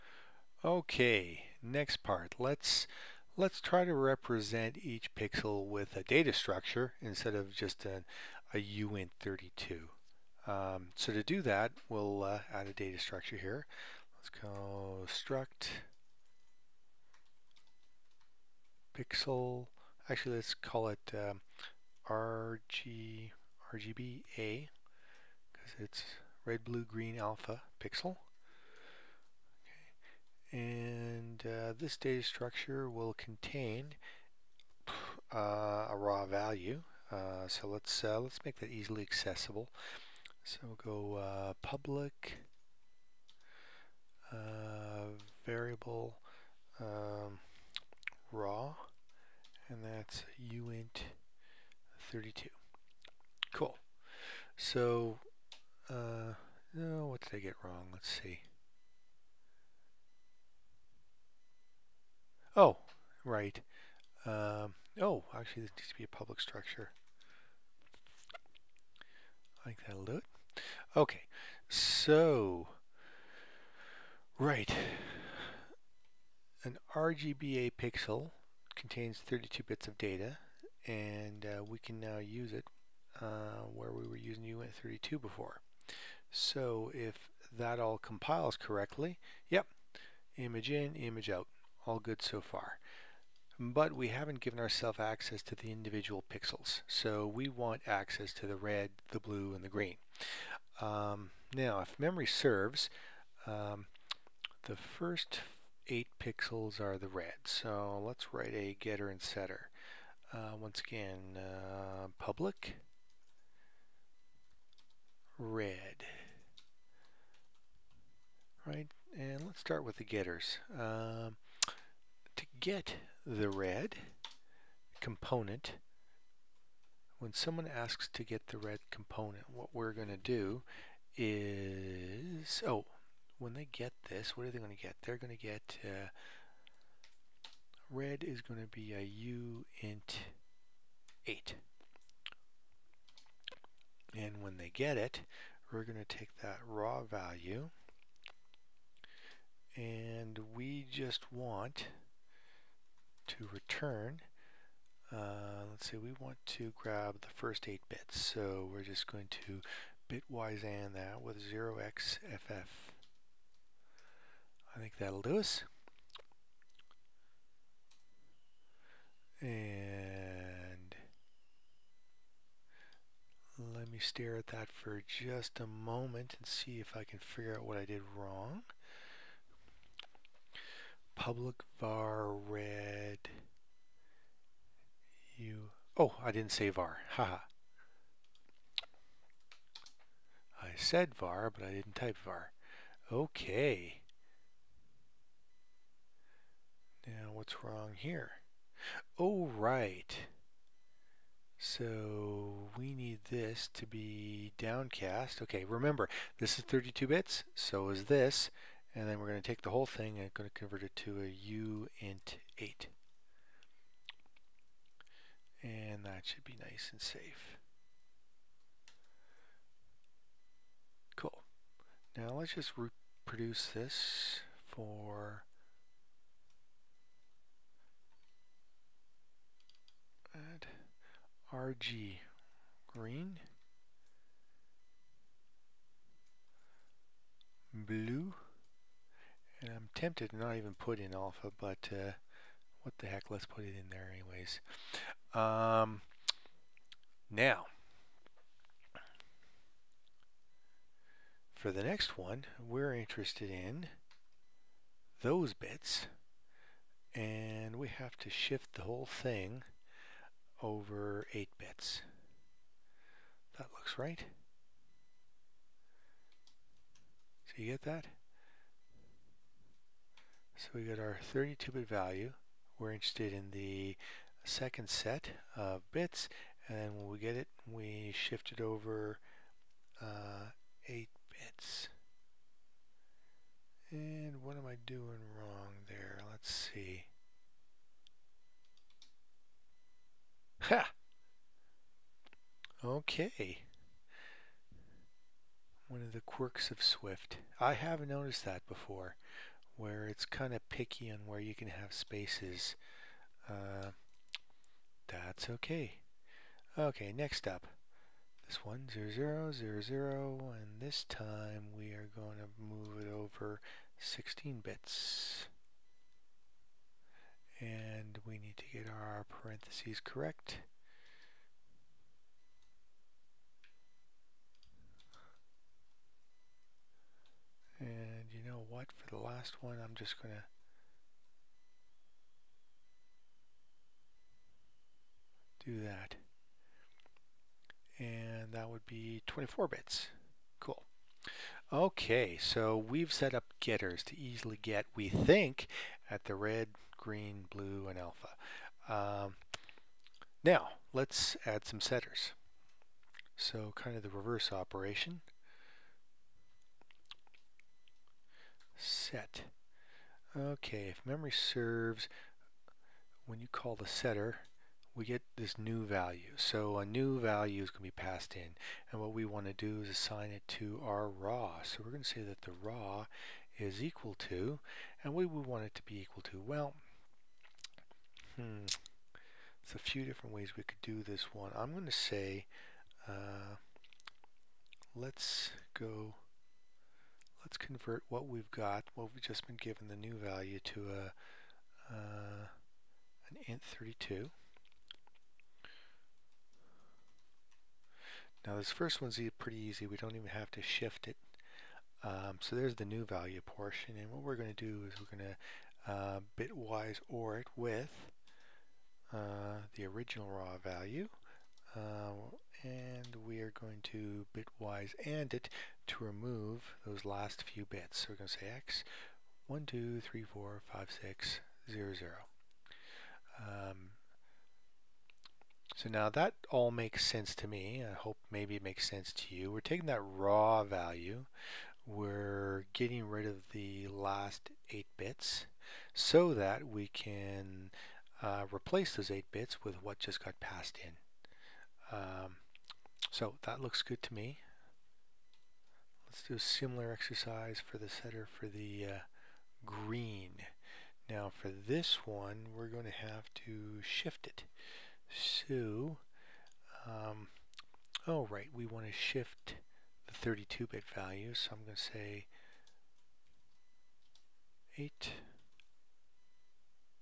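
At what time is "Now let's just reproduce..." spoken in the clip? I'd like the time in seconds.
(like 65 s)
222 s.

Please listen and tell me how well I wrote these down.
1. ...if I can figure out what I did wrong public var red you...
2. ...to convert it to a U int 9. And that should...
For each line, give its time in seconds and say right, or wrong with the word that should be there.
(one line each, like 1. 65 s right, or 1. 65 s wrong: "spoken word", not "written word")
1. 176 s right
2. 210 s wrong: "8", not "9".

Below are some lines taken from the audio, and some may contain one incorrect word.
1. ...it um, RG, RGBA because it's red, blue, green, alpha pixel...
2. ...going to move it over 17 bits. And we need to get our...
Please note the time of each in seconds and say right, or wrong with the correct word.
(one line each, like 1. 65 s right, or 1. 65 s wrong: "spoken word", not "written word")
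1. 20 s right
2. 312 s wrong: "16", not "17".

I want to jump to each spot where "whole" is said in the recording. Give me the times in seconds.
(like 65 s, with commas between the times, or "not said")
209 s, 258 s.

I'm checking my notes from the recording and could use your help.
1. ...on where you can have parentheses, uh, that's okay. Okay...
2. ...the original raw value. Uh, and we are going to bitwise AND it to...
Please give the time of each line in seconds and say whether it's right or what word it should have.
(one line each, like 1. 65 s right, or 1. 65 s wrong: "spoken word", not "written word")
1. 301 s wrong: "spaces", not "parentheses"
2. 409 s right.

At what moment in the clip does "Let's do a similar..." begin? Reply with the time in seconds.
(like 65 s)
446 s.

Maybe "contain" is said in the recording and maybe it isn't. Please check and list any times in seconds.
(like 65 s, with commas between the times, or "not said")
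33 s, 78 s.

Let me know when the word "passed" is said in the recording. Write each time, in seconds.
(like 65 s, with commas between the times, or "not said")
368 s, 440 s.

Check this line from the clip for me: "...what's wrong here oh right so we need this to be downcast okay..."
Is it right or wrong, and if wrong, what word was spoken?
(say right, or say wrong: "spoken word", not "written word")
right.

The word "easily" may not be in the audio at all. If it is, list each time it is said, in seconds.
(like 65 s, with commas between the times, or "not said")
38 s, 344 s.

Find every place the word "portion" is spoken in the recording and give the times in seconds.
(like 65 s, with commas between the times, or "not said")
403 s.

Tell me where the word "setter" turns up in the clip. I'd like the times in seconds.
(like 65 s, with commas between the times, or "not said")
109 s, 351 s, 363 s.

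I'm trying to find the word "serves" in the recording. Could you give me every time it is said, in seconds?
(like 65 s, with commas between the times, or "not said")
102 s, 361 s.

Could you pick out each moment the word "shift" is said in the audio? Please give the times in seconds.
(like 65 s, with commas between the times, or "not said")
258 s, 278 s, 400 s, 453 s, 458 s.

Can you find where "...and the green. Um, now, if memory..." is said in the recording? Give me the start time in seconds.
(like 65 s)
99 s.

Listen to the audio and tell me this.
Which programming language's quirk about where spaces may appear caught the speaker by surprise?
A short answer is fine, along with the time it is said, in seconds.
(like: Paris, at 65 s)
Swift, at 296 s.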